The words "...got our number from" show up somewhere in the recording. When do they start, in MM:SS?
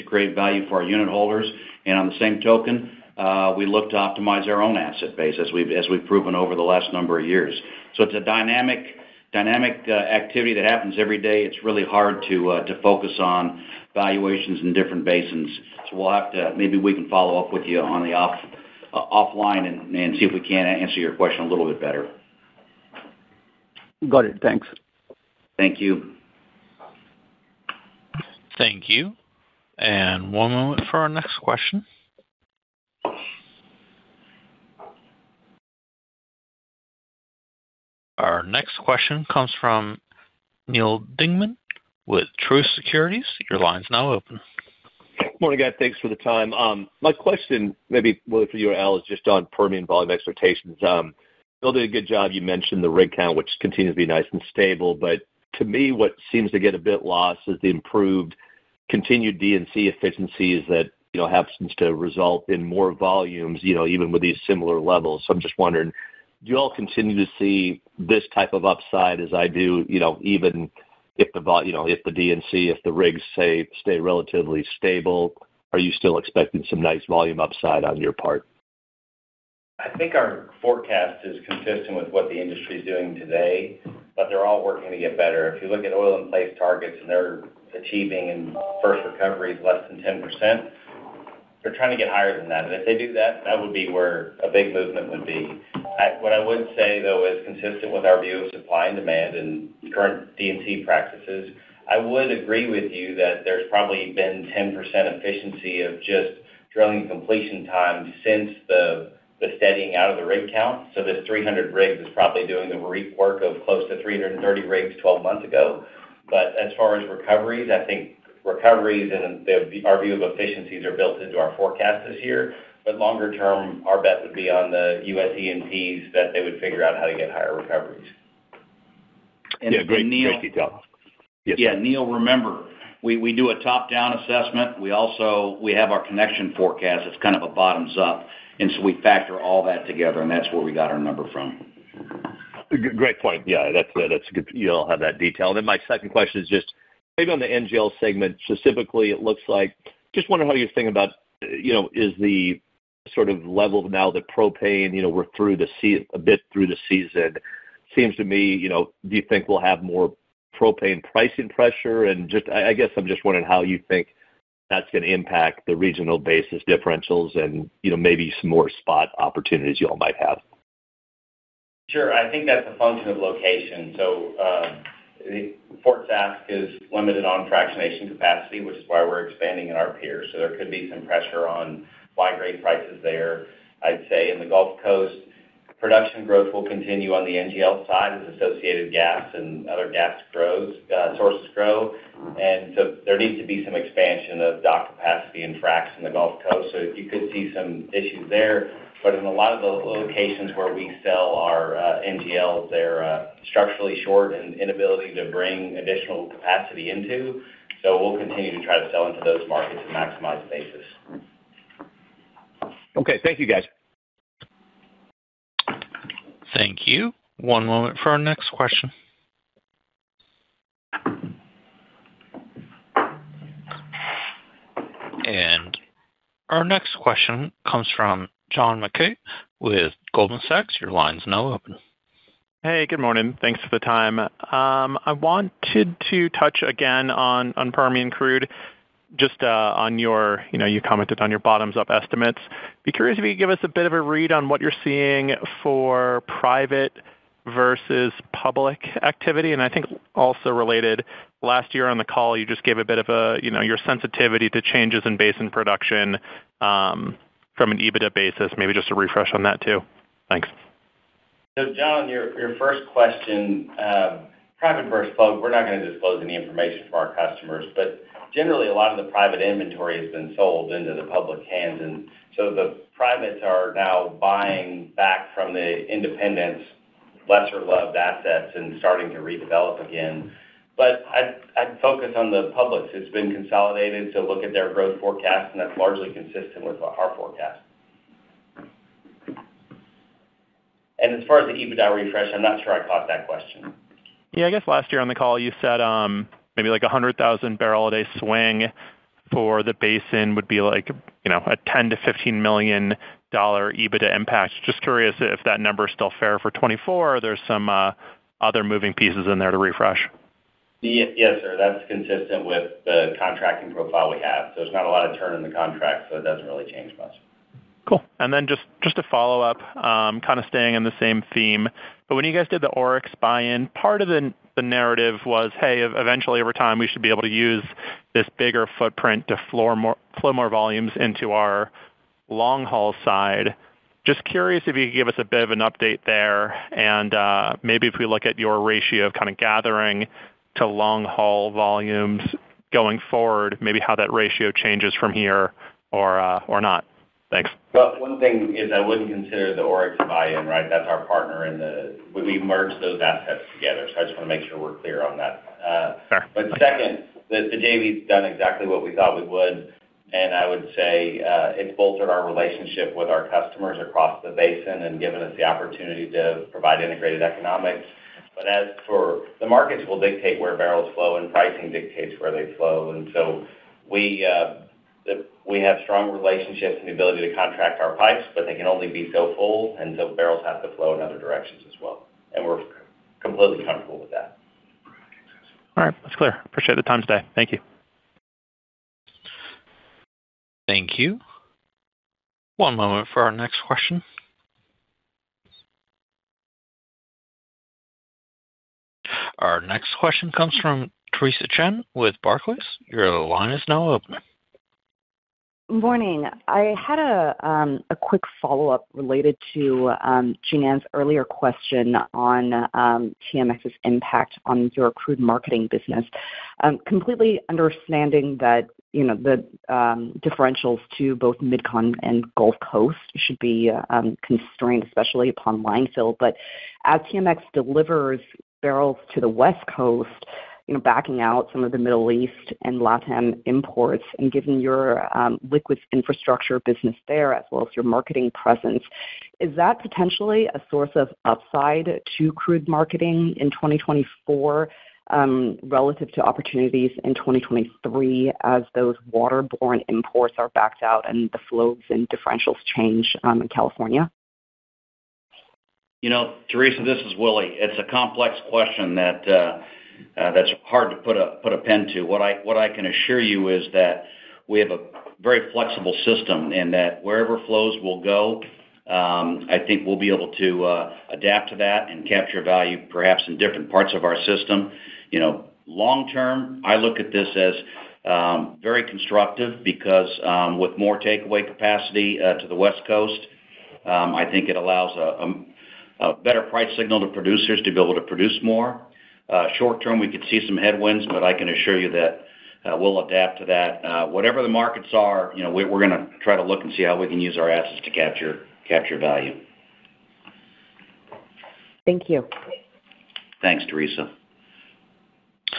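02:20.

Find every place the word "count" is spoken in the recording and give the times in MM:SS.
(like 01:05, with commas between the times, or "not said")
00:53, 01:50.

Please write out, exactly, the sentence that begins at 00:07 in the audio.
It's a dynamic dynamic uh, activity that happens every day, it's really hard to uh, focus on valuations in different basins.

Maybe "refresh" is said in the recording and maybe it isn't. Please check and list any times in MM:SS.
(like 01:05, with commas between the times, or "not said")
04:18, 04:51, 05:09.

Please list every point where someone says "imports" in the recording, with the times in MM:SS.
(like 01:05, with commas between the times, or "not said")
07:13, 07:29.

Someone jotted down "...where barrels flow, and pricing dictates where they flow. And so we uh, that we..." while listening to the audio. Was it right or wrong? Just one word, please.
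right.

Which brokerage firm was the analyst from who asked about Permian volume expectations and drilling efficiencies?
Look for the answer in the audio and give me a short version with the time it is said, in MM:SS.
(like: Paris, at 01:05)
Truist Securities, at 00:42.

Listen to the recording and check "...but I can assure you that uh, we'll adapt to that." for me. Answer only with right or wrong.
right.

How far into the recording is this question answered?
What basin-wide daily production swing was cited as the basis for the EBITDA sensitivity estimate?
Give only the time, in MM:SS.
04:56.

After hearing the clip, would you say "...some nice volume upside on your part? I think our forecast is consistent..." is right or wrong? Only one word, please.
right.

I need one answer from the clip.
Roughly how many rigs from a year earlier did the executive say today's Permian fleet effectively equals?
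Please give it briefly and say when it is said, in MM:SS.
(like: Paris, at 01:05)
330, at 01:54.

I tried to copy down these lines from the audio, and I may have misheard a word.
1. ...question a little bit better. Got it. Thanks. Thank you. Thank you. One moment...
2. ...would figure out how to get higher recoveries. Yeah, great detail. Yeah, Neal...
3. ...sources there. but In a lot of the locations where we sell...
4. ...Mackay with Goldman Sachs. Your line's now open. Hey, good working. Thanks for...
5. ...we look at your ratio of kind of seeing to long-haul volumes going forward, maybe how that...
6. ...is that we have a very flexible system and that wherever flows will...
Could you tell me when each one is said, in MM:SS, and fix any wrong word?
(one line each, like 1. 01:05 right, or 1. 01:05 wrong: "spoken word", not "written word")
1. 00:21 right
2. 02:06 right
3. 03:17 wrong: "issues", not "sources"
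4. 03:48 wrong: "morning", not "working"
5. 05:37 wrong: "gathering", not "seeing"
6. 07:43 right.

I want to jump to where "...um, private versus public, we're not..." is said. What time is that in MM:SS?
04:23.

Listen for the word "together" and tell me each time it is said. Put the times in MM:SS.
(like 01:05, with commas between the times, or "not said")
02:19, 05:53.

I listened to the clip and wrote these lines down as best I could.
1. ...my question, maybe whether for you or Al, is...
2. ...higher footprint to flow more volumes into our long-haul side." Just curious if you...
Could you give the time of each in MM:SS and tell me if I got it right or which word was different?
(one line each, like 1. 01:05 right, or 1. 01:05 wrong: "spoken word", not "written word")
1. 00:47 right
2. 05:28 wrong: "bigger", not "higher".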